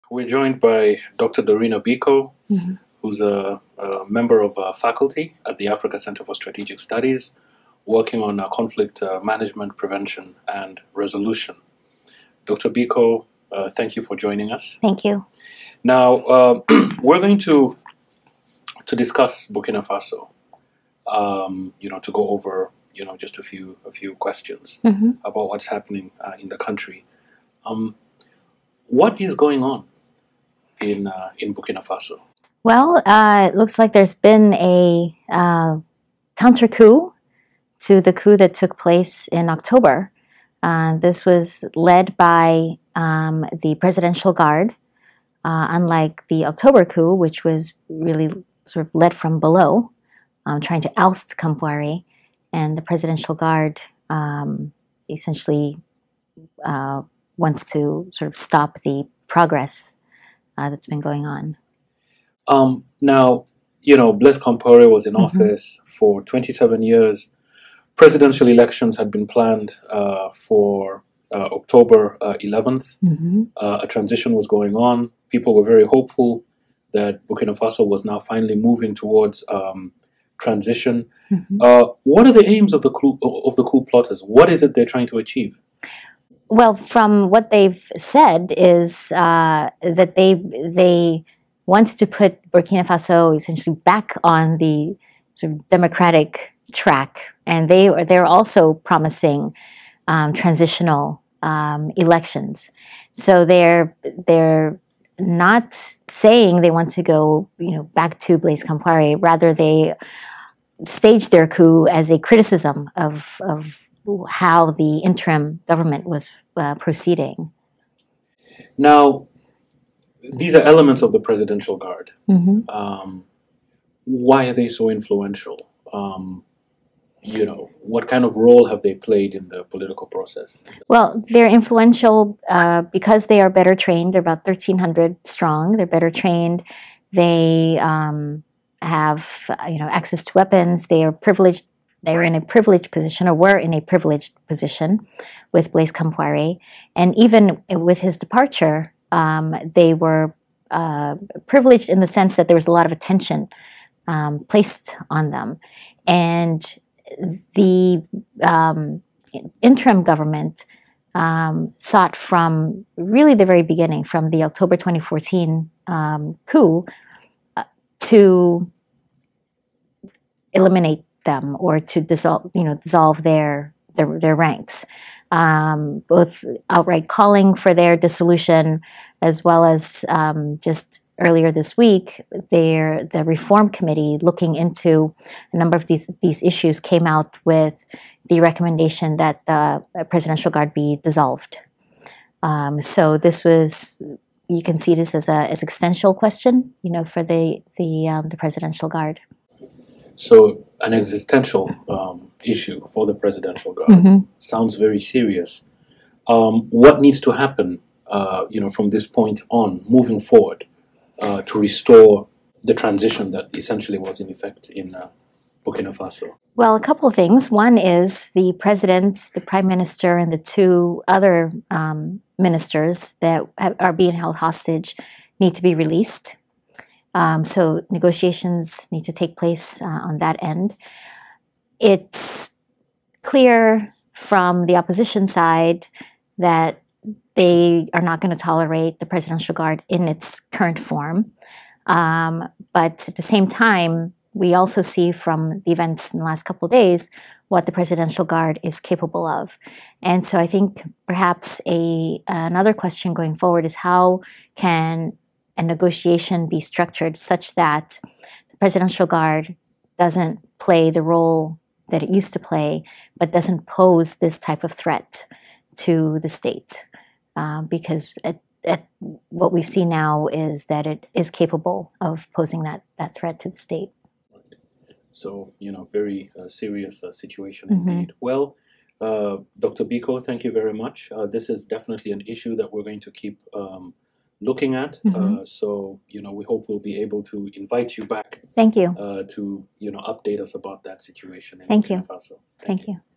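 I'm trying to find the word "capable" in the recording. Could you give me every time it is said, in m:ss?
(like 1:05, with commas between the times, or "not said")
4:08, 4:31.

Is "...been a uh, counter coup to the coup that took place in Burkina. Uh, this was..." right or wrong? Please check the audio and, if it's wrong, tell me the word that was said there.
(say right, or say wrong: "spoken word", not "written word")
wrong: "October", not "Burkina".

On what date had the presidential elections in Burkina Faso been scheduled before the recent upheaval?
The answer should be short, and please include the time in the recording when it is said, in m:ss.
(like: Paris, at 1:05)
October 11th, at 1:11.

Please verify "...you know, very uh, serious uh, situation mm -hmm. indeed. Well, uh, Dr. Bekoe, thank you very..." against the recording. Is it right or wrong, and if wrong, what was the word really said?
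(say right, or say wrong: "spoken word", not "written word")
right.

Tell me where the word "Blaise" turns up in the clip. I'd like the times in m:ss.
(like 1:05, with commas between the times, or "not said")
1:04, 1:48, 2:25.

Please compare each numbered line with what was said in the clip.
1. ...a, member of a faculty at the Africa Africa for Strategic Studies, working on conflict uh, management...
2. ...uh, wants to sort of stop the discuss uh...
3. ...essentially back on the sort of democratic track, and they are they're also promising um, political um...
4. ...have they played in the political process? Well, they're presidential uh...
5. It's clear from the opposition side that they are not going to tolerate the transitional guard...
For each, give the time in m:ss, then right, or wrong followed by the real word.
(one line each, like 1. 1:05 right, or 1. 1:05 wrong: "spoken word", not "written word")
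1. 0:03 wrong: "Center", not "Africa"
2. 0:56 wrong: "progress", not "discuss"
3. 1:33 wrong: "transitional", not "political"
4. 2:08 wrong: "influential", not "presidential"
5. 3:51 wrong: "presidential", not "transitional".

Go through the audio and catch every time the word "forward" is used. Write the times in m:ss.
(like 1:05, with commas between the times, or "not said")
3:30, 4:13.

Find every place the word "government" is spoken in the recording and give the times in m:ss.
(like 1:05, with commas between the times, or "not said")
1:55, 2:40.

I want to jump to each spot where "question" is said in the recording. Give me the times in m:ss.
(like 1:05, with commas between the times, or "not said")
0:24, 3:16, 4:12.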